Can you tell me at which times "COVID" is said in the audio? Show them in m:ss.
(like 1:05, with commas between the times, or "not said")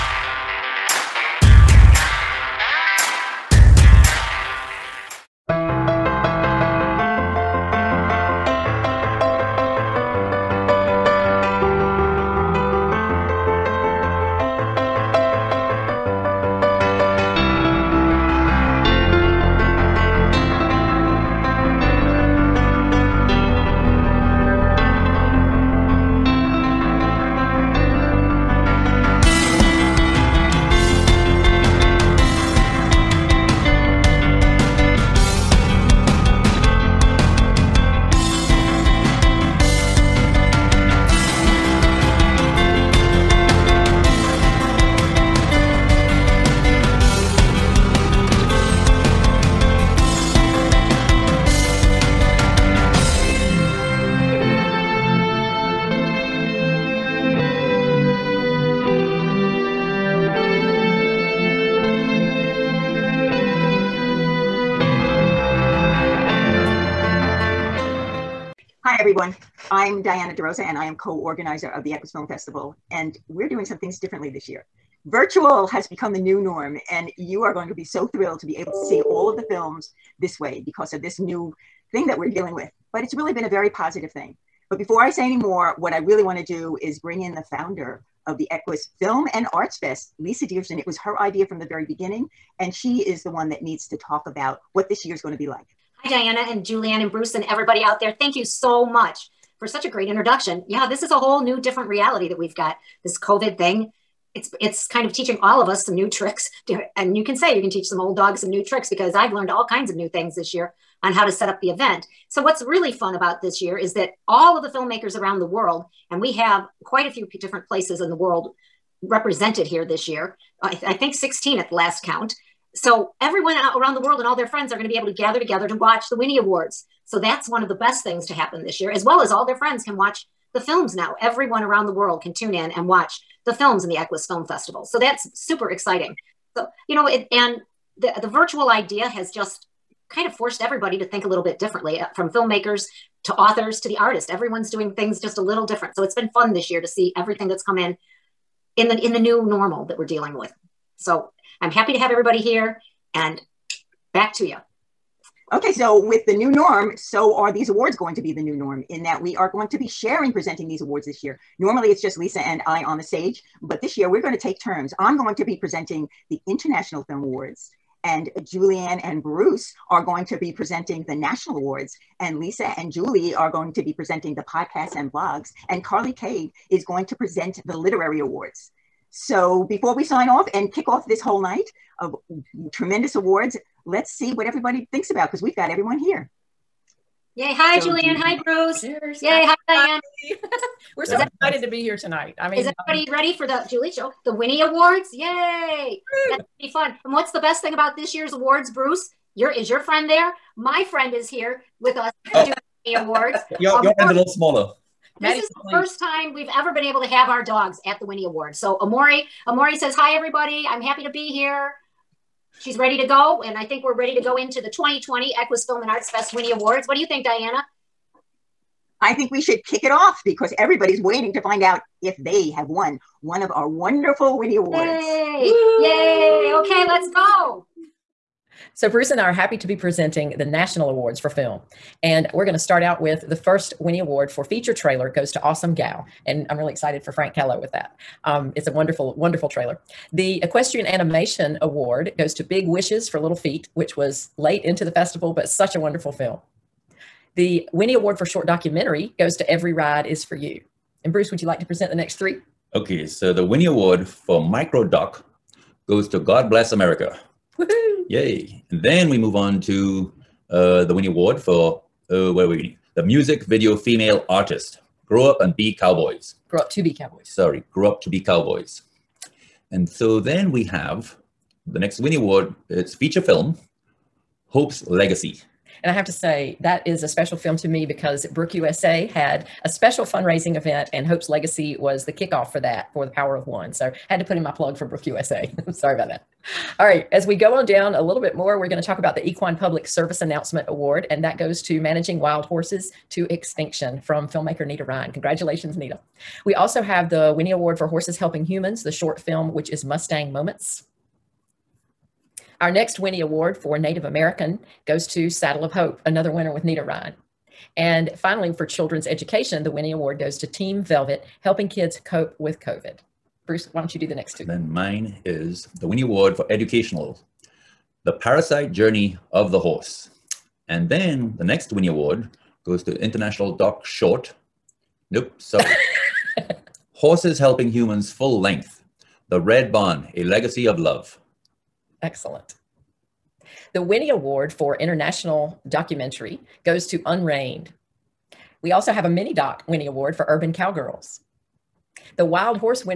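1:43, 5:12.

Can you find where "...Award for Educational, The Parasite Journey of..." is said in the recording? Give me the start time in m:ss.
5:16.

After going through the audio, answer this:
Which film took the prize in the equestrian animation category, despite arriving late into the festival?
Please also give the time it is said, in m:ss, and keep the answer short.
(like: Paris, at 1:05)
Big Wishes for Little Feet, at 4:02.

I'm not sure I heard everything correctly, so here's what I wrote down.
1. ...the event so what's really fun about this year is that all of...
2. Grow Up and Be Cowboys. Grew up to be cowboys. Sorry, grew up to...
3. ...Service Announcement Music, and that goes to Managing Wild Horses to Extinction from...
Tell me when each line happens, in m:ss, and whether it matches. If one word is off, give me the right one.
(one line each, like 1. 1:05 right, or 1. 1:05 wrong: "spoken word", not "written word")
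1. 1:51 right
2. 4:25 right
3. 4:49 wrong: "Award", not "Music".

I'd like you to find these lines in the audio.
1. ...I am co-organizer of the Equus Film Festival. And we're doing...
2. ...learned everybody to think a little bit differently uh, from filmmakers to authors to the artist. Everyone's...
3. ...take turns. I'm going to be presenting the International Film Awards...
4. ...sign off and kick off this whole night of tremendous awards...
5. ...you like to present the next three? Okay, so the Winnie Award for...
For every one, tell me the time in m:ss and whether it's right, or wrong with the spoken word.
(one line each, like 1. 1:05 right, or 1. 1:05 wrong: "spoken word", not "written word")
1. 1:10 right
2. 2:20 wrong: "forced", not "learned"
3. 2:44 right
4. 3:00 right
5. 4:11 right.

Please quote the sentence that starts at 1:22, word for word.
But it's really been a very positive thing.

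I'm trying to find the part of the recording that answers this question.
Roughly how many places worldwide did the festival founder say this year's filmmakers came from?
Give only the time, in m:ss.
2:01.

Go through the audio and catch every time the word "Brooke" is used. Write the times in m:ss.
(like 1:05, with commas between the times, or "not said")
4:38, 4:44.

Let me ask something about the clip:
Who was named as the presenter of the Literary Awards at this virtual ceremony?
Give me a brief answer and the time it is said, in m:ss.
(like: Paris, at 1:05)
Carly Kade, at 2:55.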